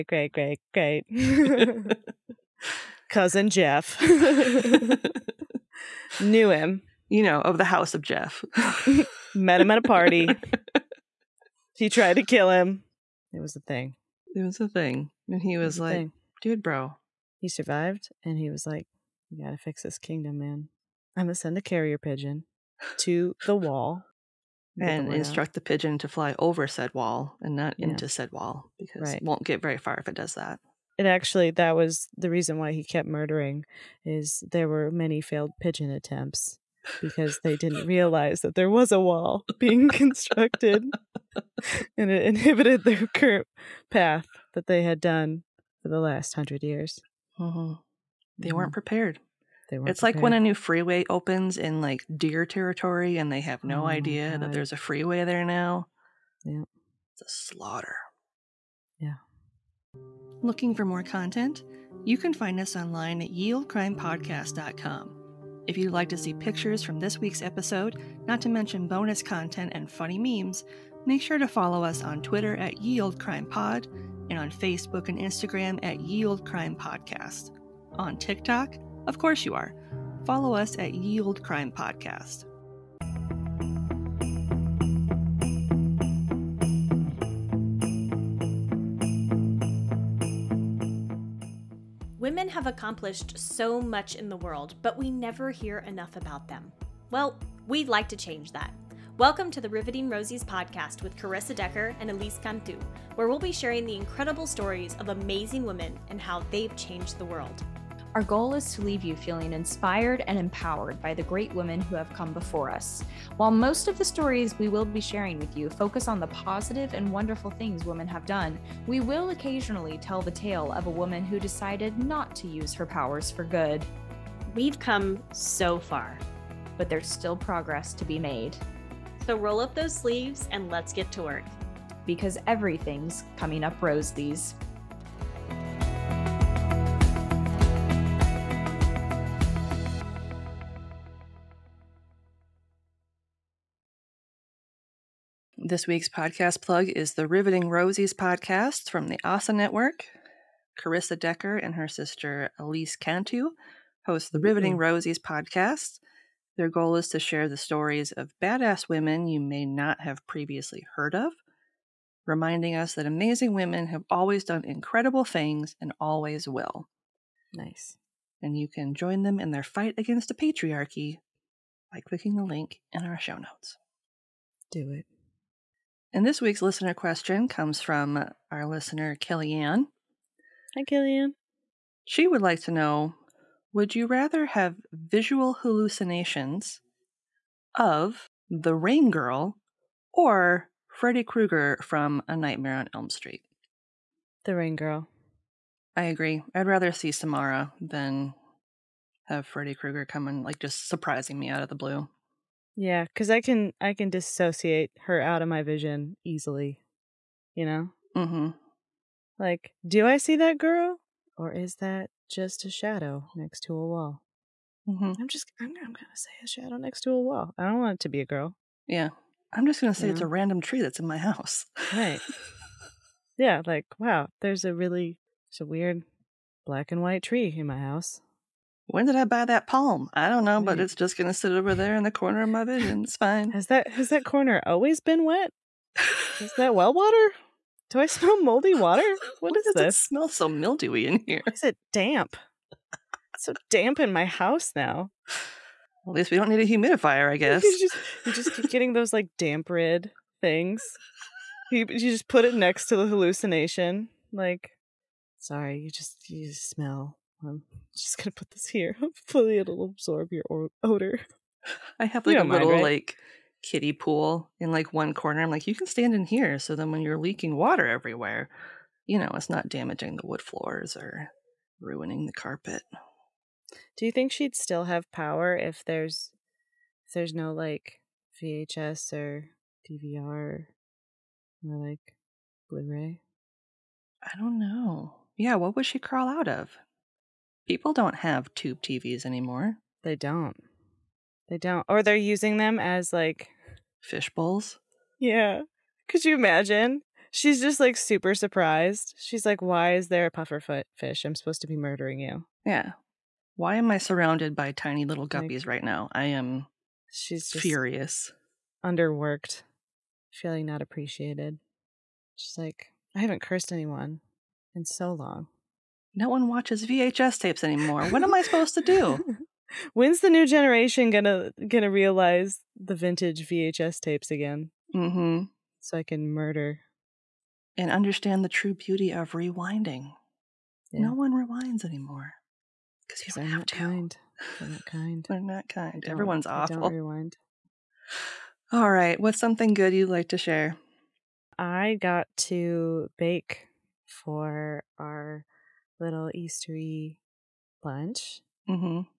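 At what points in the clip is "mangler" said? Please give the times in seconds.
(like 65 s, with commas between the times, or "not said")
not said.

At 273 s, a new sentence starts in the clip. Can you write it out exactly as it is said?
Do you think she'd still have power if there's if there's no like VHS or DVR or like Blu-ray?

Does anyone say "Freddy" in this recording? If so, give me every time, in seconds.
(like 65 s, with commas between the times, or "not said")
190 s, 199 s.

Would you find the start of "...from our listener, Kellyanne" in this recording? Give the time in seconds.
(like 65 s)
177 s.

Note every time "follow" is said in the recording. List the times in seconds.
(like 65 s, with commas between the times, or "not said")
71 s, 80 s.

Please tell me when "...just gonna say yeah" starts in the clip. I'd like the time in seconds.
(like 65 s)
219 s.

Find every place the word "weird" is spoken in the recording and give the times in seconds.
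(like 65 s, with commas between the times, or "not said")
225 s.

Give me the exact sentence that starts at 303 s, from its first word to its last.
Why am I surrounded by tiny little guppies like, right now?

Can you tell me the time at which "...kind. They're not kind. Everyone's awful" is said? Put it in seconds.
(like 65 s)
334 s.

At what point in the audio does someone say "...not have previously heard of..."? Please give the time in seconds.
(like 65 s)
159 s.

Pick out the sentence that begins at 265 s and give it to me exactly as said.
I'm like, you can stand in here.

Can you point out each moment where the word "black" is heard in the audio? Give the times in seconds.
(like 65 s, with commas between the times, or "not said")
226 s.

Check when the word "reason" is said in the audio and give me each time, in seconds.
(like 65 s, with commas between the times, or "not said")
32 s.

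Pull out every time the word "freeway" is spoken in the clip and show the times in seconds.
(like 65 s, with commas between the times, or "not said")
50 s, 54 s.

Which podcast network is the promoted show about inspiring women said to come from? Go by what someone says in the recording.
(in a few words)
ASA Network.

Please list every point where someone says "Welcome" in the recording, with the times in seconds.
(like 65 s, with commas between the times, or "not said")
99 s.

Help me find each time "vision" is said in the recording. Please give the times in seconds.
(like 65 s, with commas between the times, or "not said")
205 s, 232 s.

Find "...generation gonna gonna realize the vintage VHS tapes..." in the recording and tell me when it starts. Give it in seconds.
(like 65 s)
320 s.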